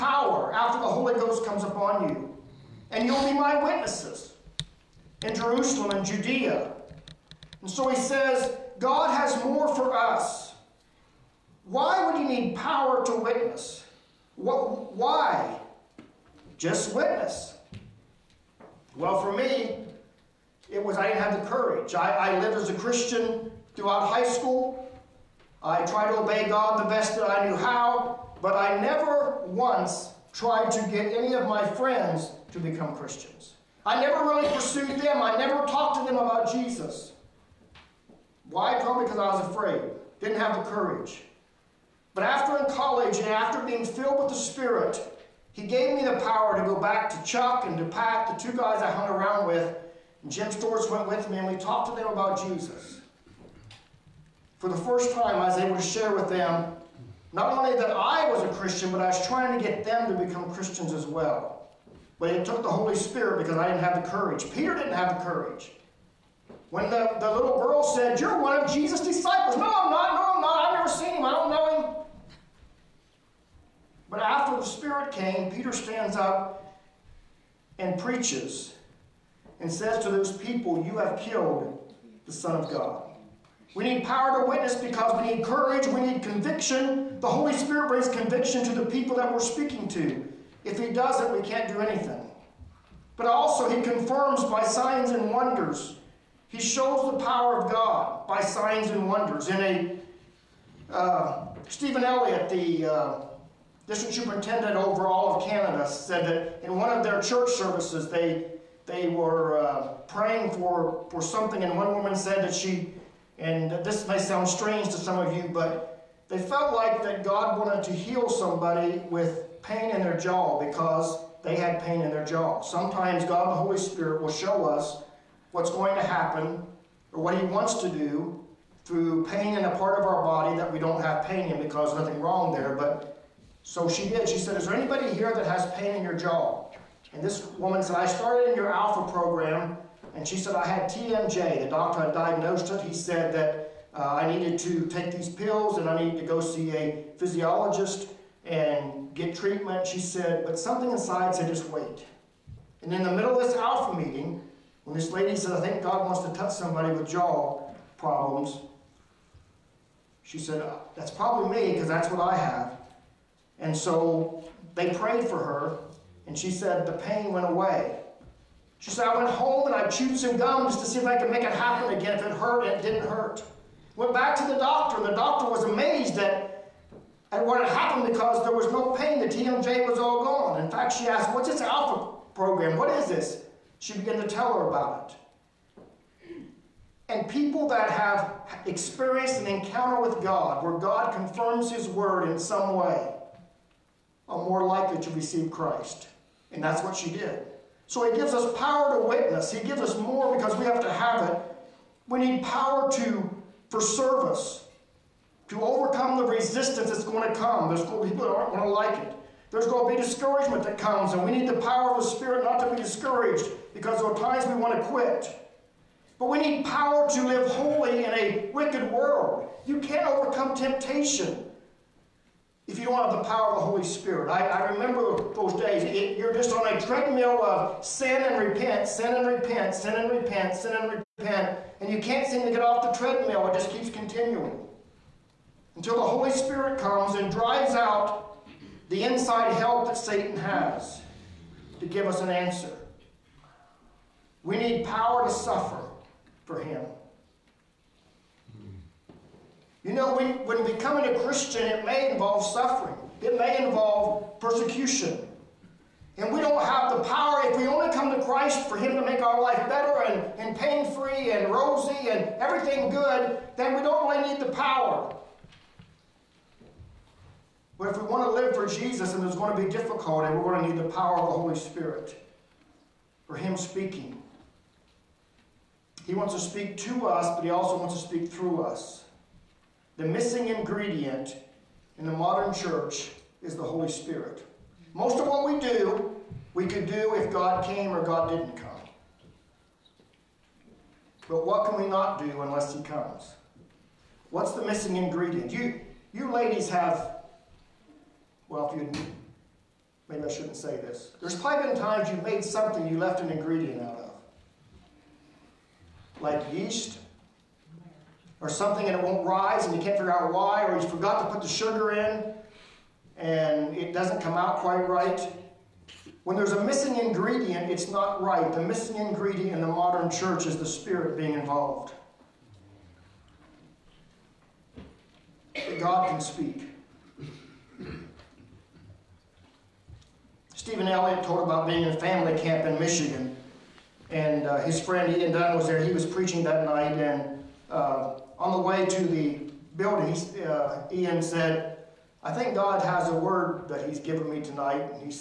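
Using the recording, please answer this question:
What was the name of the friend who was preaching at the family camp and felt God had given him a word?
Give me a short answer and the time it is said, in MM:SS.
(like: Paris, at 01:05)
Ian Dunn, at 05:35.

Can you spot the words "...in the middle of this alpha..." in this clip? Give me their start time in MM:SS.
02:32.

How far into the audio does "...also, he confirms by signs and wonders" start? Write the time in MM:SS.
01:33.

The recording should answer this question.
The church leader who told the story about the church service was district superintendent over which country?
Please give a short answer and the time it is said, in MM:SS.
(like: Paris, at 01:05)
Canada, at 01:45.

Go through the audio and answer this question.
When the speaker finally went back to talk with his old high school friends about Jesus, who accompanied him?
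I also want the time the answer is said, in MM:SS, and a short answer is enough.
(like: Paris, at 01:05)
Jim Storrs, at 00:50.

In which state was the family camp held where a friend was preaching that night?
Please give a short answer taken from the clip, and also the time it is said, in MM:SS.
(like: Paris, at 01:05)
Michigan, at 05:32.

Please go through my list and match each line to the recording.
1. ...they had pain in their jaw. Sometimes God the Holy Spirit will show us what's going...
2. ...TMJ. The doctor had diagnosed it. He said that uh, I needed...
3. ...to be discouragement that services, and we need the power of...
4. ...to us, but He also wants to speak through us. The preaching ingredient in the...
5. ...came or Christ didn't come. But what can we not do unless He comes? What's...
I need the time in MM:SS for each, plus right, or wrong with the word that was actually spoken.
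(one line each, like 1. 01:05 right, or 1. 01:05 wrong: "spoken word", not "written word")
1. 02:01 right
2. 02:20 right
3. 03:29 wrong: "comes", not "services"
4. 04:36 wrong: "missing", not "preaching"
5. 04:47 wrong: "God", not "Christ".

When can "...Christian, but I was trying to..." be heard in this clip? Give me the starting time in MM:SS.
00:58.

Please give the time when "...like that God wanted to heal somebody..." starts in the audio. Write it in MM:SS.
01:56.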